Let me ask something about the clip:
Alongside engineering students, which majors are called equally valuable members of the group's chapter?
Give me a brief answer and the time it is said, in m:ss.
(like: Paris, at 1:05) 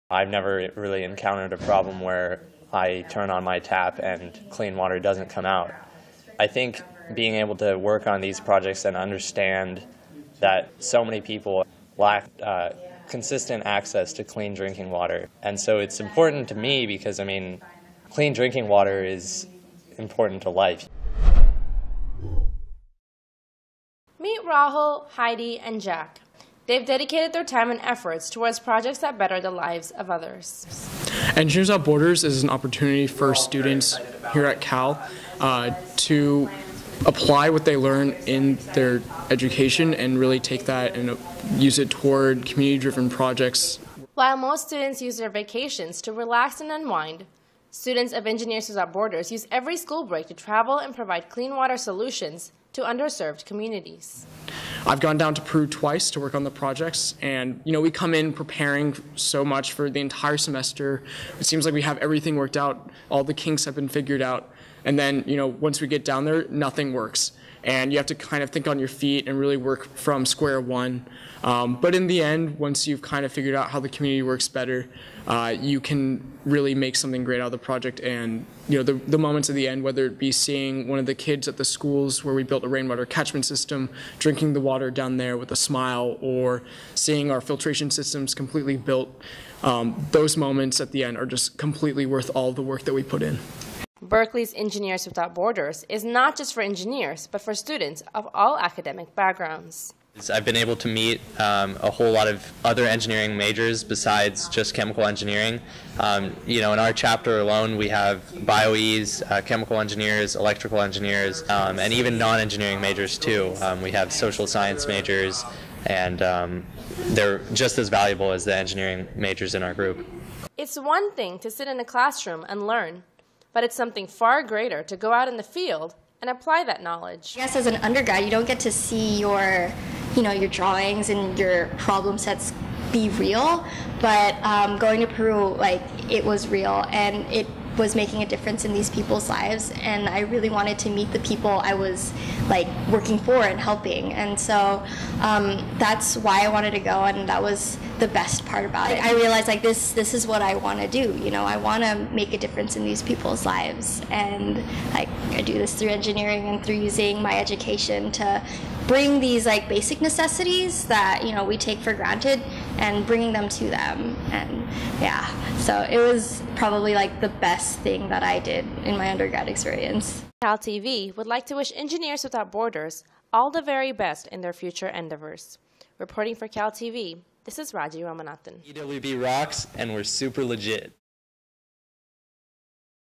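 social science majors, at 1:54.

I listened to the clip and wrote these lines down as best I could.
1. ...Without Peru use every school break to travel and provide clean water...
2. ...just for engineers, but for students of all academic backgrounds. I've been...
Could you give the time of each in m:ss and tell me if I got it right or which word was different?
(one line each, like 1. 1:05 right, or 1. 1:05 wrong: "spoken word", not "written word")
1. 0:48 wrong: "Borders", not "Peru"
2. 1:36 right.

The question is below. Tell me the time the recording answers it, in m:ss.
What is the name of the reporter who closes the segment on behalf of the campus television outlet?
2:57.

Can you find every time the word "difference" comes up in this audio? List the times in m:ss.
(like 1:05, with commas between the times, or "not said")
2:18, 2:32.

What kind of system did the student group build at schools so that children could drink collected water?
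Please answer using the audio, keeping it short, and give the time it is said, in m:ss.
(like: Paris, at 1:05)
rainwater catchment system, at 1:22.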